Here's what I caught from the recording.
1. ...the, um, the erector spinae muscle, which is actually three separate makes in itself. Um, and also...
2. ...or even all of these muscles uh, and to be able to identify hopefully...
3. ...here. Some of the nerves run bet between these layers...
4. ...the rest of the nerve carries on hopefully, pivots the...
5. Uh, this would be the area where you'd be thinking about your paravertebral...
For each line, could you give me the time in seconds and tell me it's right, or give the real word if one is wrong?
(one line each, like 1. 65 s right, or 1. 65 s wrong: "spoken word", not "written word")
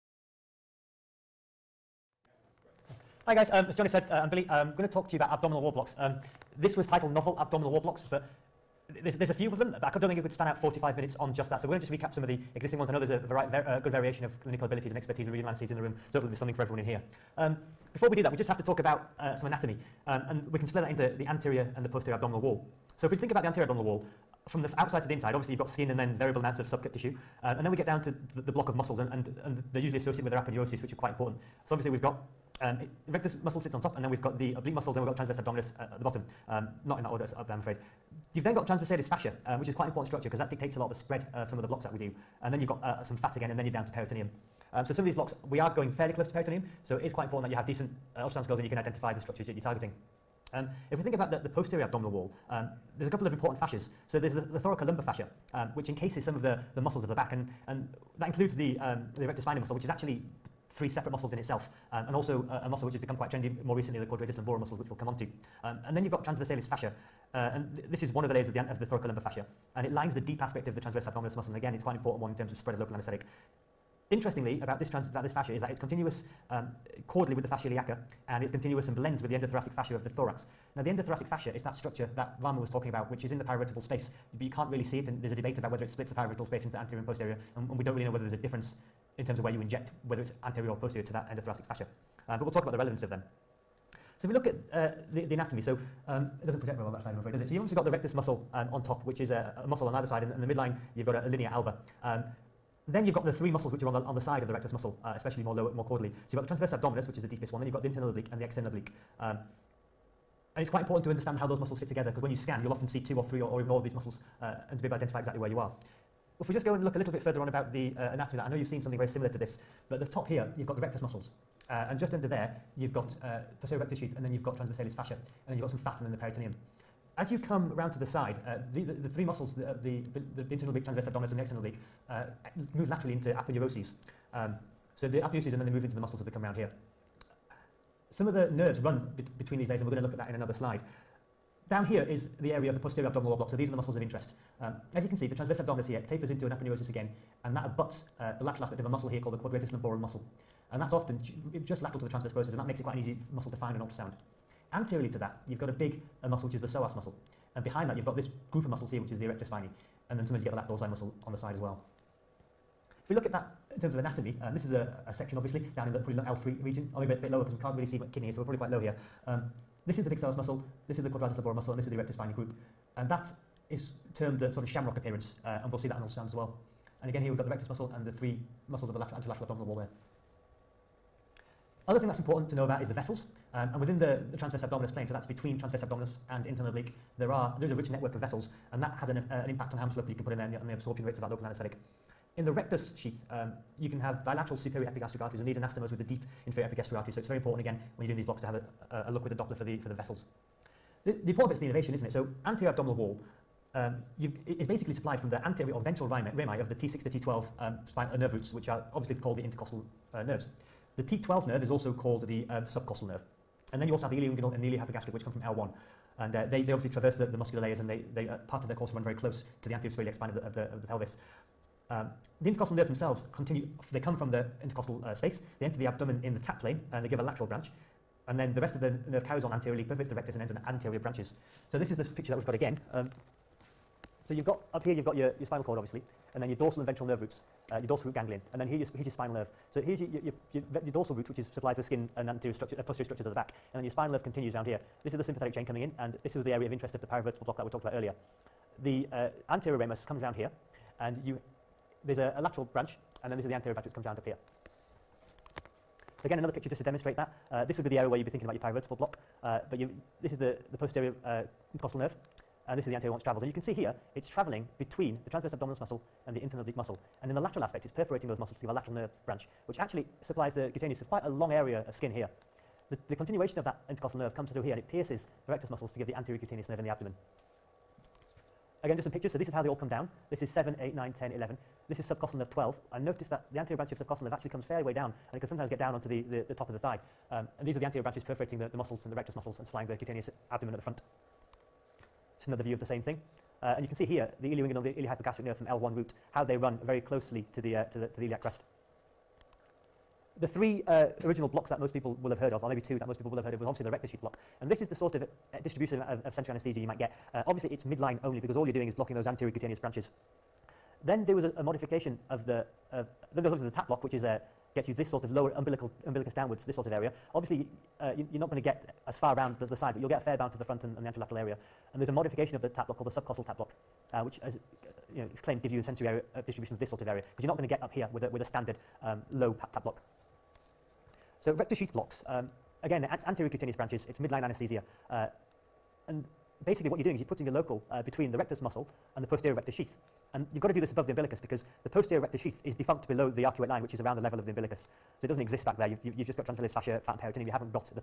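1. 58 s wrong: "muscles", not "makes"
2. 113 s wrong: "exactly", not "hopefully"
3. 136 s right
4. 228 s wrong: "anteriorly", not "hopefully"
5. 257 s right.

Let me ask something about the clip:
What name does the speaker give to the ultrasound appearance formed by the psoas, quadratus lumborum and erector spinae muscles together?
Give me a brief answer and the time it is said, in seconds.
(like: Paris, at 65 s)
shamrock appearance, at 174 s.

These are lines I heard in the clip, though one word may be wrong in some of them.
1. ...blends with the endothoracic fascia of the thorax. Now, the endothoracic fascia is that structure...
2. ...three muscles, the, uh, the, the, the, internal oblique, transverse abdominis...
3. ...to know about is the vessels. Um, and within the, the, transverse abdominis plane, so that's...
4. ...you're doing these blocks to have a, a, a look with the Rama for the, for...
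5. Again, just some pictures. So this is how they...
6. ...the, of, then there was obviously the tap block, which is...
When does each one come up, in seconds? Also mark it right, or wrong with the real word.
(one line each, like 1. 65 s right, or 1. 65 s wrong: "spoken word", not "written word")
1. 78 s right
2. 129 s right
3. 182 s right
4. 198 s wrong: "Doppler", not "Rama"
5. 278 s right
6. 312 s right.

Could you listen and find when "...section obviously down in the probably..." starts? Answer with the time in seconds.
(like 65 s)
165 s.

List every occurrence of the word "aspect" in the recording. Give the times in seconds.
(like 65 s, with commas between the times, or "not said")
70 s, 148 s, 267 s.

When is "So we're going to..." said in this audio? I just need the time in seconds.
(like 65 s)
11 s.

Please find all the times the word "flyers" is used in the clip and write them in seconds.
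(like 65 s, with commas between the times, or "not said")
not said.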